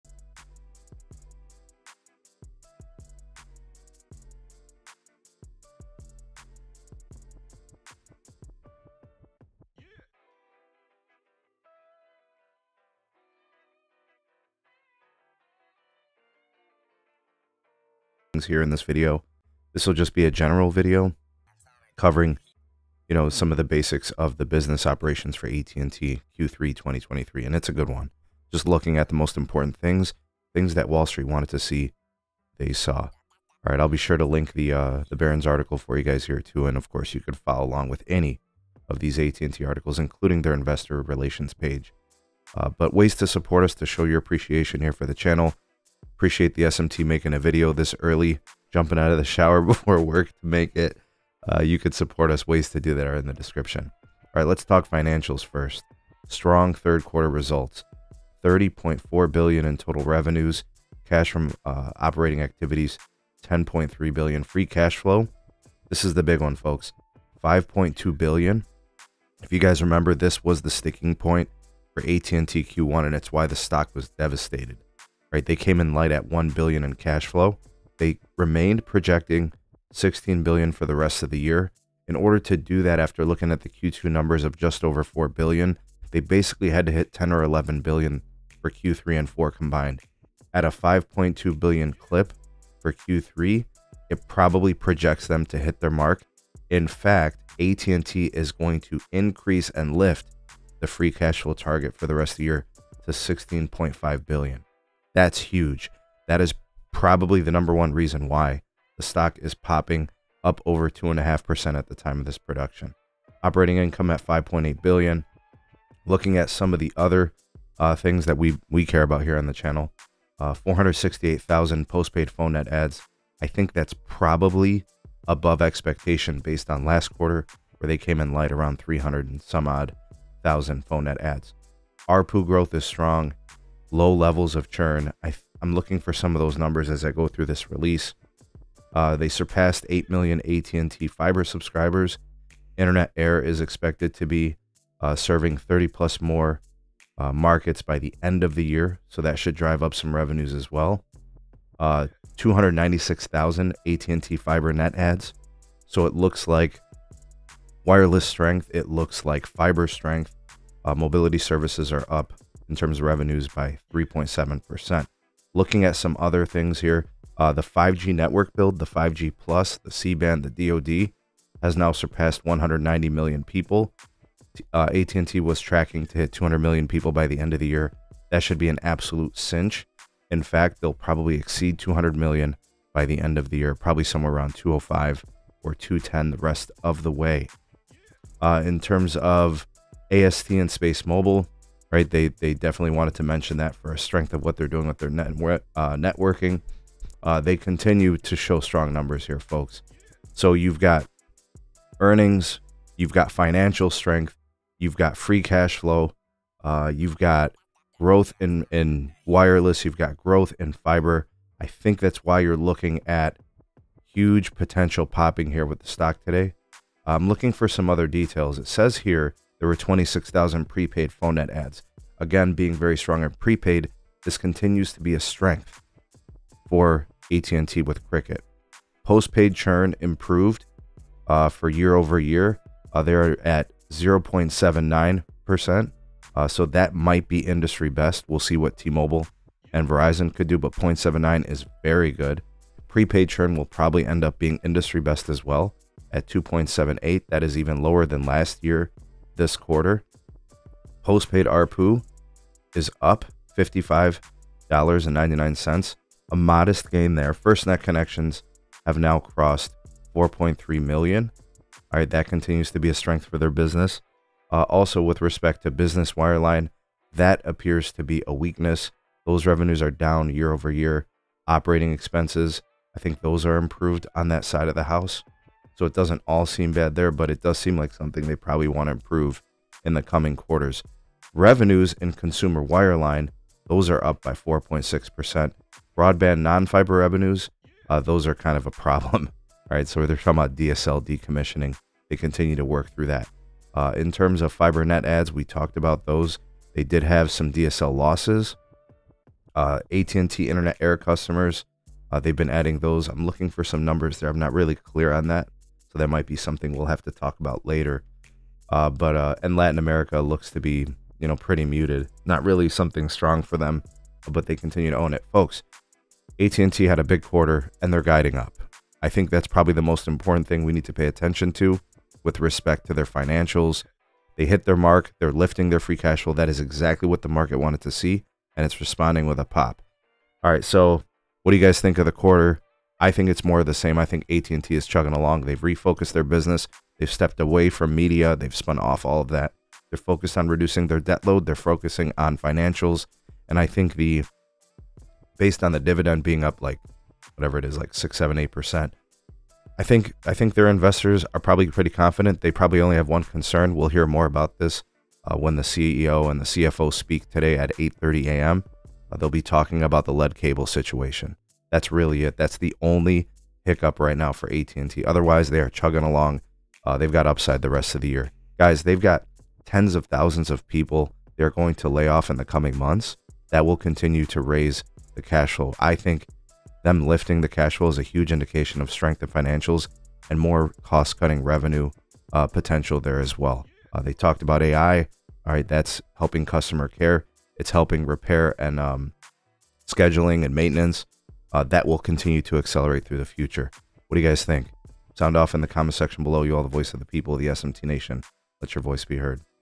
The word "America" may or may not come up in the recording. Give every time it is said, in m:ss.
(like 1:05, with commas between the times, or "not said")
5:09.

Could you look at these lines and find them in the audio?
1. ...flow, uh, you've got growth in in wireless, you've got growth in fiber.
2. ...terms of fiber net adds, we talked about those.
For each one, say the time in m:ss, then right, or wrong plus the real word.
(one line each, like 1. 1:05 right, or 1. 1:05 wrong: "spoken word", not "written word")
1. 3:25 right
2. 4:54 right.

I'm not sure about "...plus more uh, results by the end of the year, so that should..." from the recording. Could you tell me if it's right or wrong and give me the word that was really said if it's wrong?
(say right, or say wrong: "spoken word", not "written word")
wrong: "markets", not "results".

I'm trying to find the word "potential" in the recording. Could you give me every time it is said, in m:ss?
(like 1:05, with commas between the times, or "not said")
3:34, 6:22.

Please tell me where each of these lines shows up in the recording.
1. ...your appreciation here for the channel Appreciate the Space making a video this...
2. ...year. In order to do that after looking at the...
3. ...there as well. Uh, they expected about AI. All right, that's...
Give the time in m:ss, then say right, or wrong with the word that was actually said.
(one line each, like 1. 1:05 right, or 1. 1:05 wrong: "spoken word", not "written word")
1. 0:44 wrong: "SMT", not "Space"
2. 1:21 right
3. 6:22 wrong: "talked", not "expected".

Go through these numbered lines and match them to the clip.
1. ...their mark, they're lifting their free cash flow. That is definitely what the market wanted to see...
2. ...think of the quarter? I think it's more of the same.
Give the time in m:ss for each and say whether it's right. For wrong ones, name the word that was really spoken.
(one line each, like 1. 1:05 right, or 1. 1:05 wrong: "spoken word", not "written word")
1. 5:24 wrong: "exactly", not "definitely"
2. 5:31 right.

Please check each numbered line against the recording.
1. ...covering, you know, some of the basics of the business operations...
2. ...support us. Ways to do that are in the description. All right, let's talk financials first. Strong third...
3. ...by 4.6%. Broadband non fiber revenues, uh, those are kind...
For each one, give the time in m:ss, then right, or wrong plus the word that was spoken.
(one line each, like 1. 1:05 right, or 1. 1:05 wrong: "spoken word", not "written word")
1. 0:21 right
2. 0:51 right
3. 4:44 right.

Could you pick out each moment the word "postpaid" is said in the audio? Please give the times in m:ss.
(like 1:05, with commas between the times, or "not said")
2:01, 3:49, 4:11.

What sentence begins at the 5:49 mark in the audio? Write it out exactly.
I think I think their investors are probably pretty confident.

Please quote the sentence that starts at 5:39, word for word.
They're focused on reducing their debt load.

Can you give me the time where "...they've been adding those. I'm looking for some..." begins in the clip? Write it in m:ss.
5:02.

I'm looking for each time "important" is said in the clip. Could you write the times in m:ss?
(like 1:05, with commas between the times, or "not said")
0:29, 5:20.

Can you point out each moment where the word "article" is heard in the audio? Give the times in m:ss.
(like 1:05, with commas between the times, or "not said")
0:35, 0:39.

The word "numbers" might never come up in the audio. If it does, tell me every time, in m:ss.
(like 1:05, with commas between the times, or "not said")
1:24, 1:47, 2:16, 3:18, 5:03.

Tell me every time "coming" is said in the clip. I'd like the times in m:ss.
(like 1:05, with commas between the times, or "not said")
4:40, 6:12.